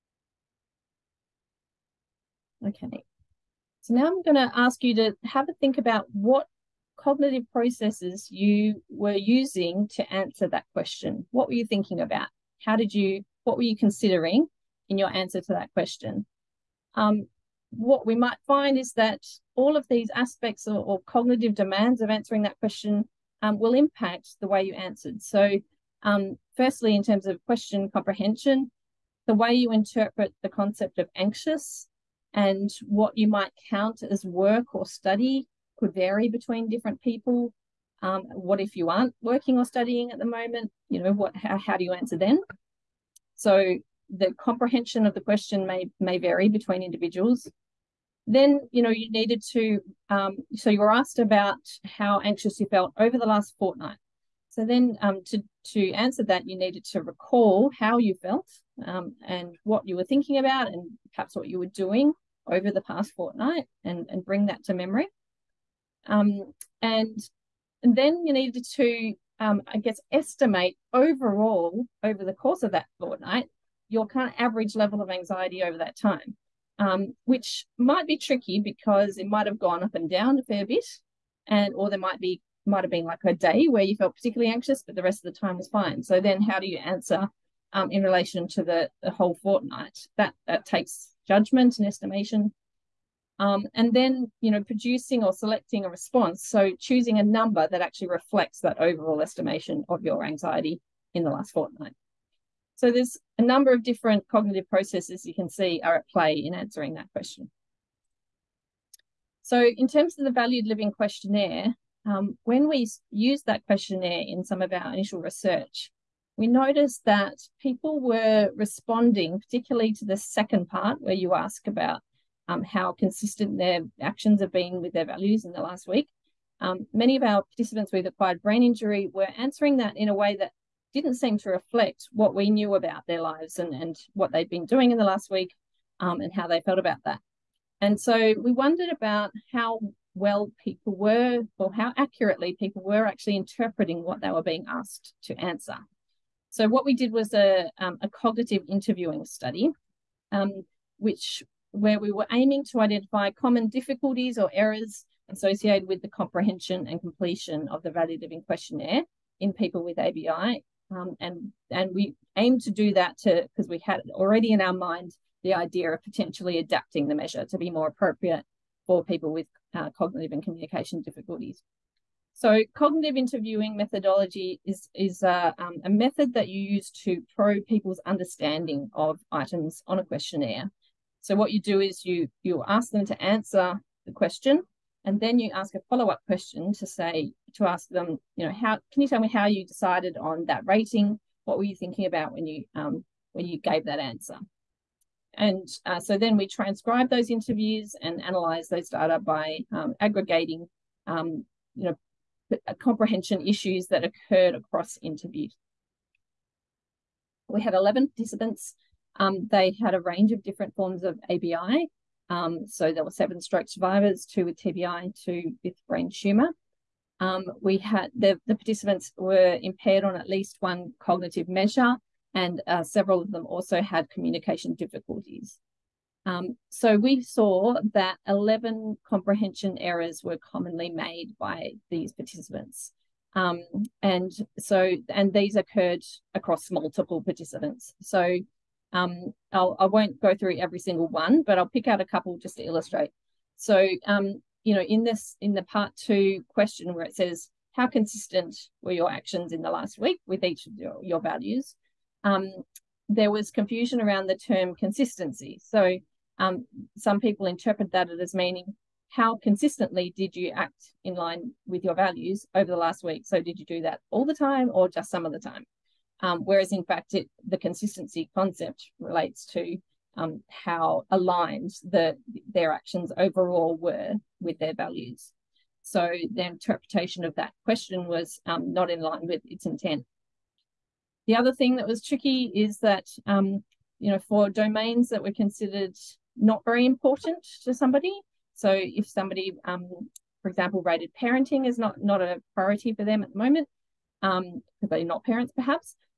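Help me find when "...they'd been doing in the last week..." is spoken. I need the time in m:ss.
2:14.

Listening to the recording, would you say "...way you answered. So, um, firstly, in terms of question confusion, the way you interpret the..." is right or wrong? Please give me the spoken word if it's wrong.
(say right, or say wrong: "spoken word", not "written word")
wrong: "comprehension", not "confusion".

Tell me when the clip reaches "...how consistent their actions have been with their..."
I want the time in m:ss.
2:02.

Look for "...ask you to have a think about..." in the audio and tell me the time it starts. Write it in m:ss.
0:04.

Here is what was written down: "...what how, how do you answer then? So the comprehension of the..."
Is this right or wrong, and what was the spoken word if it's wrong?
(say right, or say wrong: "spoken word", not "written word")
right.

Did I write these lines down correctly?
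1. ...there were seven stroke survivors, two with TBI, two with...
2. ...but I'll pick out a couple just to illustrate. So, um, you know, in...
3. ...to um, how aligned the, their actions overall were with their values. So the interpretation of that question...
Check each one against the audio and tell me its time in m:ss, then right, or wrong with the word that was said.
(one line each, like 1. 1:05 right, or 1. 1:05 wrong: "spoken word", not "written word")
1. 3:32 right
2. 4:01 right
3. 4:29 right.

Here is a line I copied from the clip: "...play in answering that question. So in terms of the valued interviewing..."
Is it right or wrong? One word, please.
wrong.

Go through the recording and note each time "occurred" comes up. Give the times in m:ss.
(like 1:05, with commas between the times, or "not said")
3:24, 3:55.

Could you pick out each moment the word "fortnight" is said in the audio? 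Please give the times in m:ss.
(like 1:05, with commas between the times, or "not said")
0:53, 1:03, 1:12, 1:29, 1:41.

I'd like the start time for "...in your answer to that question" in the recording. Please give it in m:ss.
0:14.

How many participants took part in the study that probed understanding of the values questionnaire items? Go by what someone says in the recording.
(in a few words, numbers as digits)
11.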